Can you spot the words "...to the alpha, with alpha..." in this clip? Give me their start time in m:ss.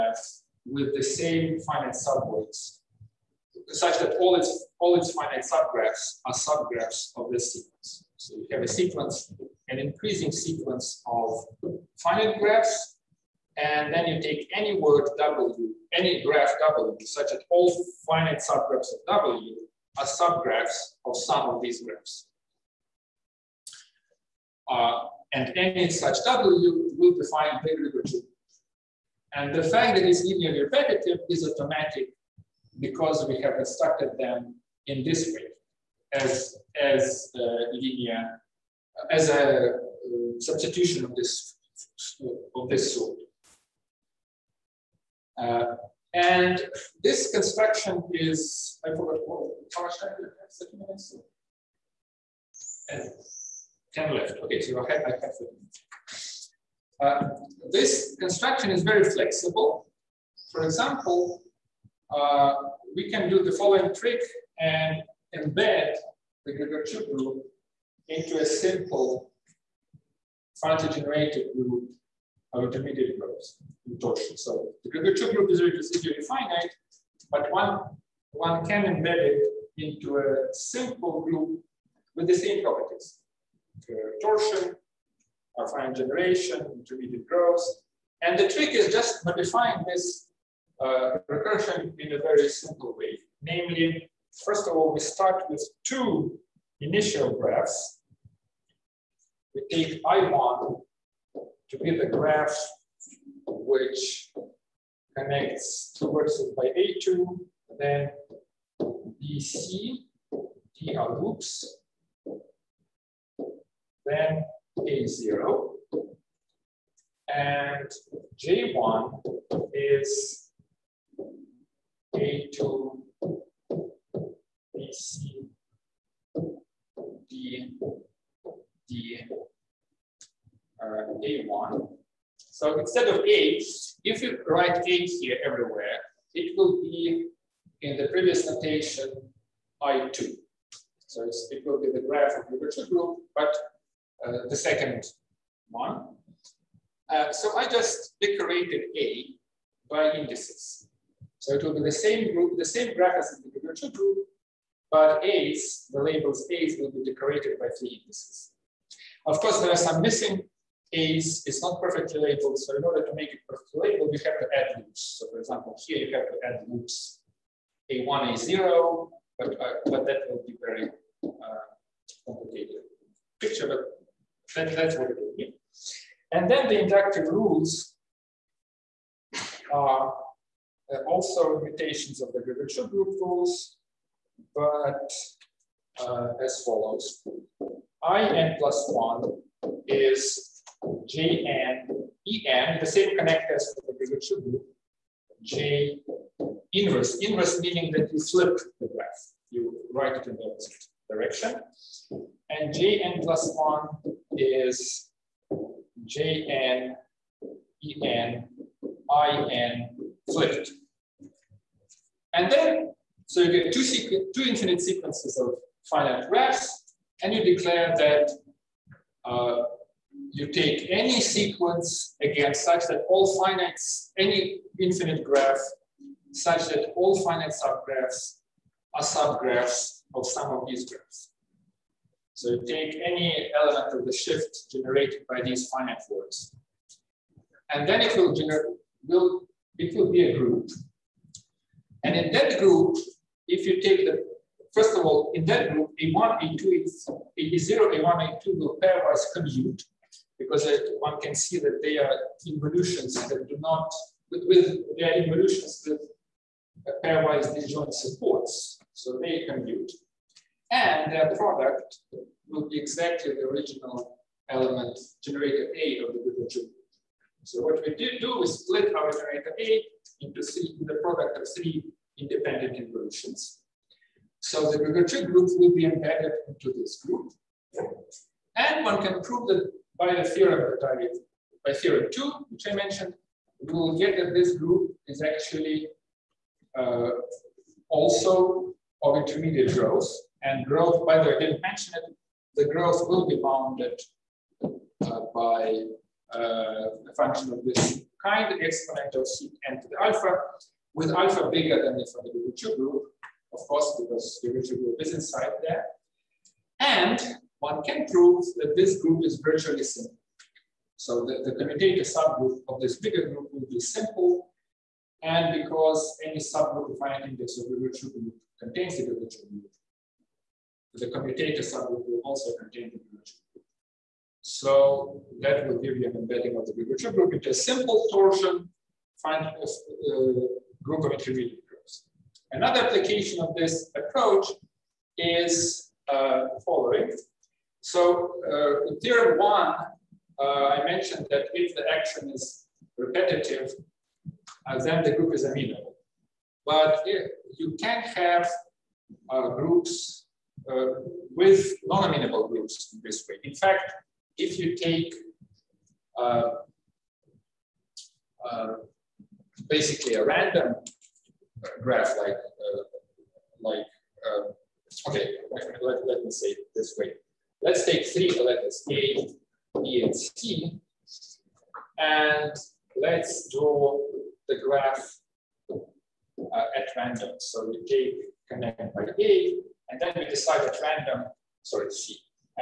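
4:59.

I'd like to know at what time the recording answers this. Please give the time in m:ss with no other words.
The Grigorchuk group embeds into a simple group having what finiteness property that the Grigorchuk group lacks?
1:15.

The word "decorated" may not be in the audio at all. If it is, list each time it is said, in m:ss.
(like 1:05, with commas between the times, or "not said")
2:28, 2:37.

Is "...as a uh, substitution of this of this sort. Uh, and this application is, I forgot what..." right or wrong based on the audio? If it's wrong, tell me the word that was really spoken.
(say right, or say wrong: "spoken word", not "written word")
wrong: "construction", not "application".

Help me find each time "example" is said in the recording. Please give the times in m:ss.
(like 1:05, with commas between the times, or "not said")
1:00, 2:45.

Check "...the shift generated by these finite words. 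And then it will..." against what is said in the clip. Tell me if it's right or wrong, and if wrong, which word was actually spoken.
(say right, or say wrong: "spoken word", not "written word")
right.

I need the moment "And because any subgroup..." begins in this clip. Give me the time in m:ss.
5:15.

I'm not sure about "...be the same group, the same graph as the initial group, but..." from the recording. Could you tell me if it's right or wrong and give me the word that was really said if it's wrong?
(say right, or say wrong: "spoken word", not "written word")
wrong: "virtual", not "initial".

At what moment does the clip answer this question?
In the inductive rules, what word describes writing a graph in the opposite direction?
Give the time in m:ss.
3:18.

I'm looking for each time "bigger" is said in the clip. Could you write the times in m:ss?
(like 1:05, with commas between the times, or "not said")
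5:01, 5:12.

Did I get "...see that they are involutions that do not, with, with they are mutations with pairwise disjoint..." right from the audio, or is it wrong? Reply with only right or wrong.
wrong.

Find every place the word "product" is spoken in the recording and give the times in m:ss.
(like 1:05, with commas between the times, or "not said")
4:21, 4:30.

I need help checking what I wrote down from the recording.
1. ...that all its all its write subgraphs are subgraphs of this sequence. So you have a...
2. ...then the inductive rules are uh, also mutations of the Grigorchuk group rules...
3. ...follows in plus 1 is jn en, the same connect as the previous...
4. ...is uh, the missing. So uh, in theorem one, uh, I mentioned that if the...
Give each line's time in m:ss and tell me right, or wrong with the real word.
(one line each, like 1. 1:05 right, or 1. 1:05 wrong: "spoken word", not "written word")
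1. 0:03 wrong: "finite", not "write"
2. 2:56 right
3. 3:06 right
4. 5:35 wrong: "following", not "missing".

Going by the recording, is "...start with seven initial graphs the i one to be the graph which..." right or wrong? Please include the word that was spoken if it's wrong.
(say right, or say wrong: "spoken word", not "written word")
wrong: "two", not "seven".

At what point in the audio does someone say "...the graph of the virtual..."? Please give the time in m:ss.
2:21.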